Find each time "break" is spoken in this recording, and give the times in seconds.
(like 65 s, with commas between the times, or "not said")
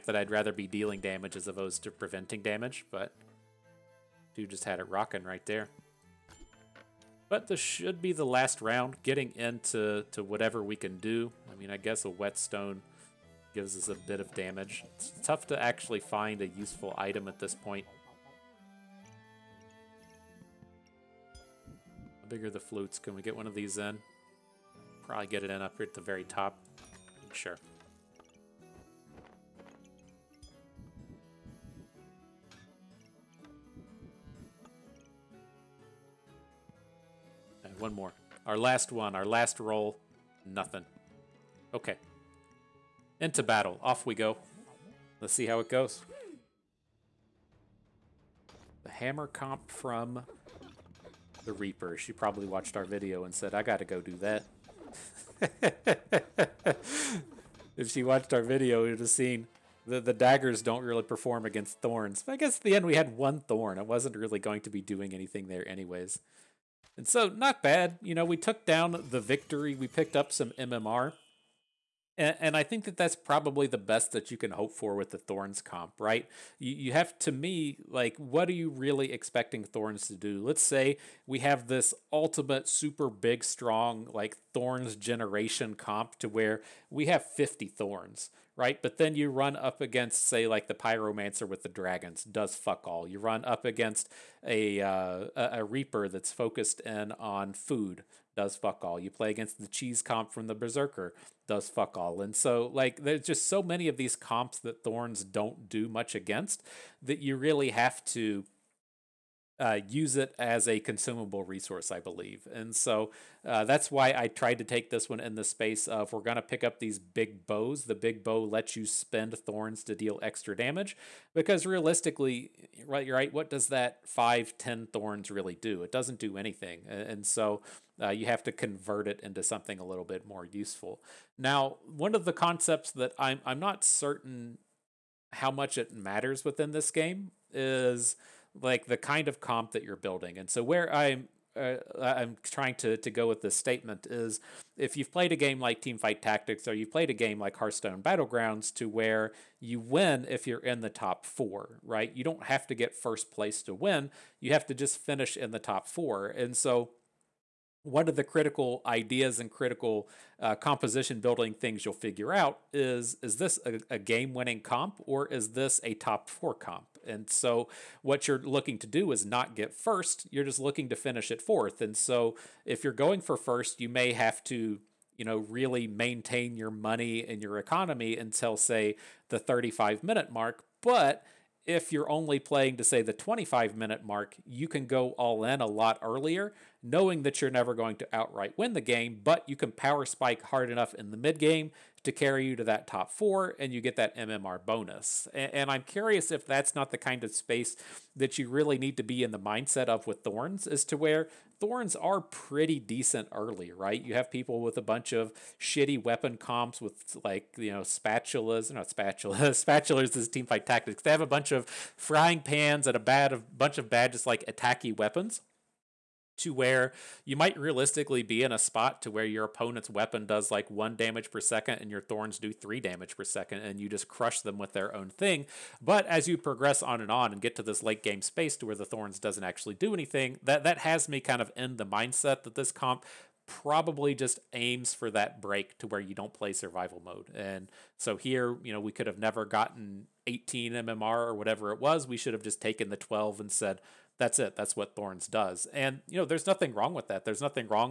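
235 s.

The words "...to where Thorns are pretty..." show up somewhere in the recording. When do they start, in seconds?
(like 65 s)
200 s.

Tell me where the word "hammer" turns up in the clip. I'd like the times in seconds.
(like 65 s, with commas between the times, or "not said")
48 s.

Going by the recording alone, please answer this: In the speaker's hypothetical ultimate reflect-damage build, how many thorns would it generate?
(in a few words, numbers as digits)
50.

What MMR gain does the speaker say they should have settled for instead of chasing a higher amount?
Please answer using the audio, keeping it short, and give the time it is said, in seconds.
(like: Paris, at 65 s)
12, at 242 s.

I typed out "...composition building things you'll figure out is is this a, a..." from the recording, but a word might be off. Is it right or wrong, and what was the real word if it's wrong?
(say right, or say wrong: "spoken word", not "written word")
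right.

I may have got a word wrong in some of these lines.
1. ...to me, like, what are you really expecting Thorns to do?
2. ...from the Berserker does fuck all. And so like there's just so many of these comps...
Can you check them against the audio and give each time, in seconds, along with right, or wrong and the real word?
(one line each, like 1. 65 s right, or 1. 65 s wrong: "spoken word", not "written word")
1. 77 s right
2. 100 s right.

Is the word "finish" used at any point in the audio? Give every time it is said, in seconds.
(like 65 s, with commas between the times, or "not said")
154 s, 170 s.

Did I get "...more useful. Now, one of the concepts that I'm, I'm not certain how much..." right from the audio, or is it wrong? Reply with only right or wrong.
right.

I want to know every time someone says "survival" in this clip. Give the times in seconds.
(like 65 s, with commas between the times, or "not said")
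236 s.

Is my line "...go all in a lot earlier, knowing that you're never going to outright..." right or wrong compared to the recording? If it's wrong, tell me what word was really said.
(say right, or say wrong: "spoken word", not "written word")
right.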